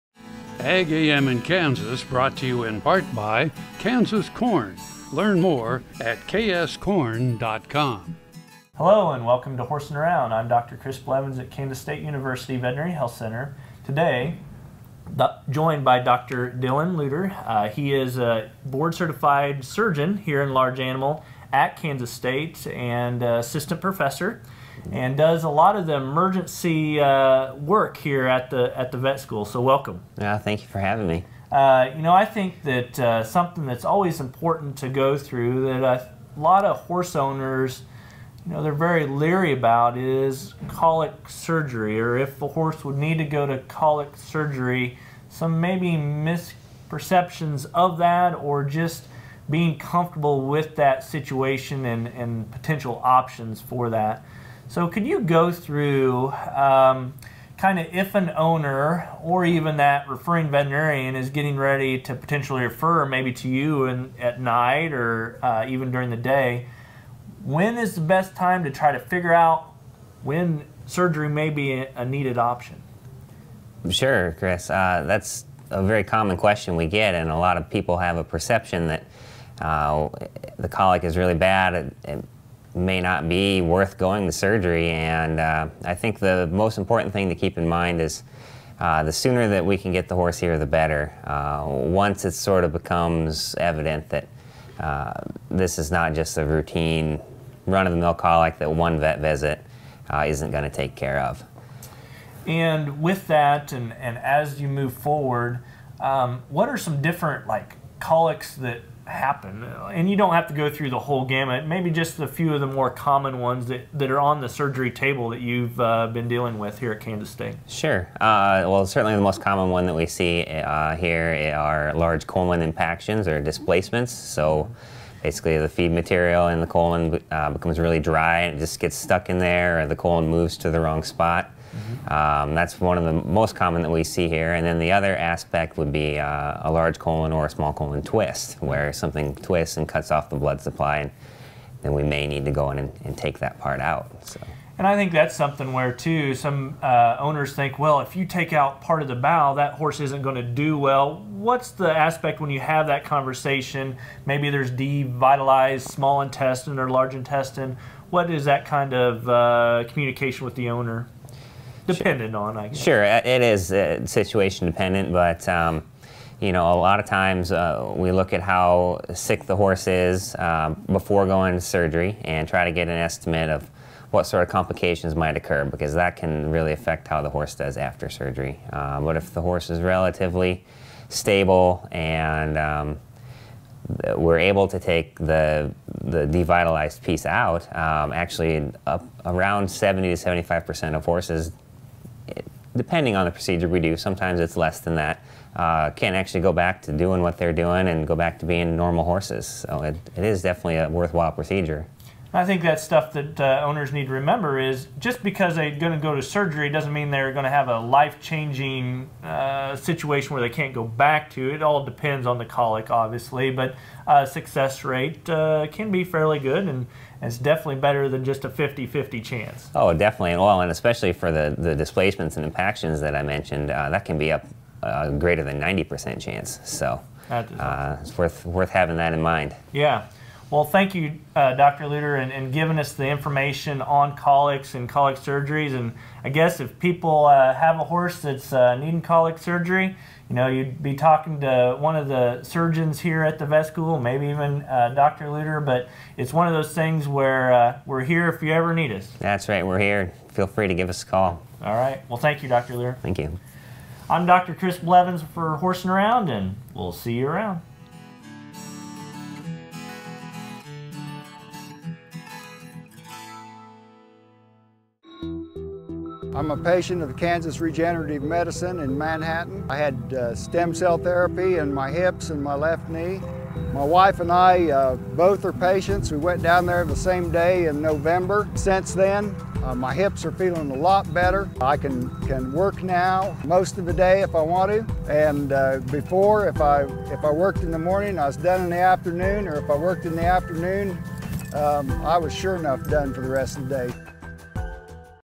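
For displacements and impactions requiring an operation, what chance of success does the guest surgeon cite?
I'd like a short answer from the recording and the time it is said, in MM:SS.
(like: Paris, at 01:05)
Greater than 90%, at 03:45.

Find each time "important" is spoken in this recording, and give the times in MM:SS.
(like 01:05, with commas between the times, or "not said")
00:34, 01:26.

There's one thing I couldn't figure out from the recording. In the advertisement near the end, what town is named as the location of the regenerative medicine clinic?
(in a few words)
Manhattan.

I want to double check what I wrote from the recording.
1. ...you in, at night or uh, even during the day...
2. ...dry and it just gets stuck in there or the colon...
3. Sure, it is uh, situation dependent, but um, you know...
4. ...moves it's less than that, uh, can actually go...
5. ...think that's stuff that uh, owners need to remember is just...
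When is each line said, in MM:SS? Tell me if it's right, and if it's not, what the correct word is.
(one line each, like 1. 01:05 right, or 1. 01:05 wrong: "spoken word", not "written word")
1. 01:03 right
2. 02:07 right
3. 02:42 right
4. 03:13 wrong: "sometimes", not "moves"
5. 03:22 right.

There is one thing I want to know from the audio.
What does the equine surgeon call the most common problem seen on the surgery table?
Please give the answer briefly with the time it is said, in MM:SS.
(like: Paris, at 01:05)
Large colon impactions or displacements, at 02:01.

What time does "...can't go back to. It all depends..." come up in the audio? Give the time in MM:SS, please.
03:30.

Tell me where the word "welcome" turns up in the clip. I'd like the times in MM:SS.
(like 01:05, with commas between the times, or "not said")
00:09, 00:29.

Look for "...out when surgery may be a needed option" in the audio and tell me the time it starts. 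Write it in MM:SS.
01:09.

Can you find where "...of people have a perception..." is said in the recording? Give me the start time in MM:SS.
01:17.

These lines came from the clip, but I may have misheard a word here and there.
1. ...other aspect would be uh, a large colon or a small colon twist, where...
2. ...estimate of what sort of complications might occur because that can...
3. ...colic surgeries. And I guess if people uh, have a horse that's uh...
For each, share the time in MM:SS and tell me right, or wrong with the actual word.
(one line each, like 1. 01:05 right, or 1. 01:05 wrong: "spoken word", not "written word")
1. 02:14 right
2. 02:52 right
3. 03:54 right.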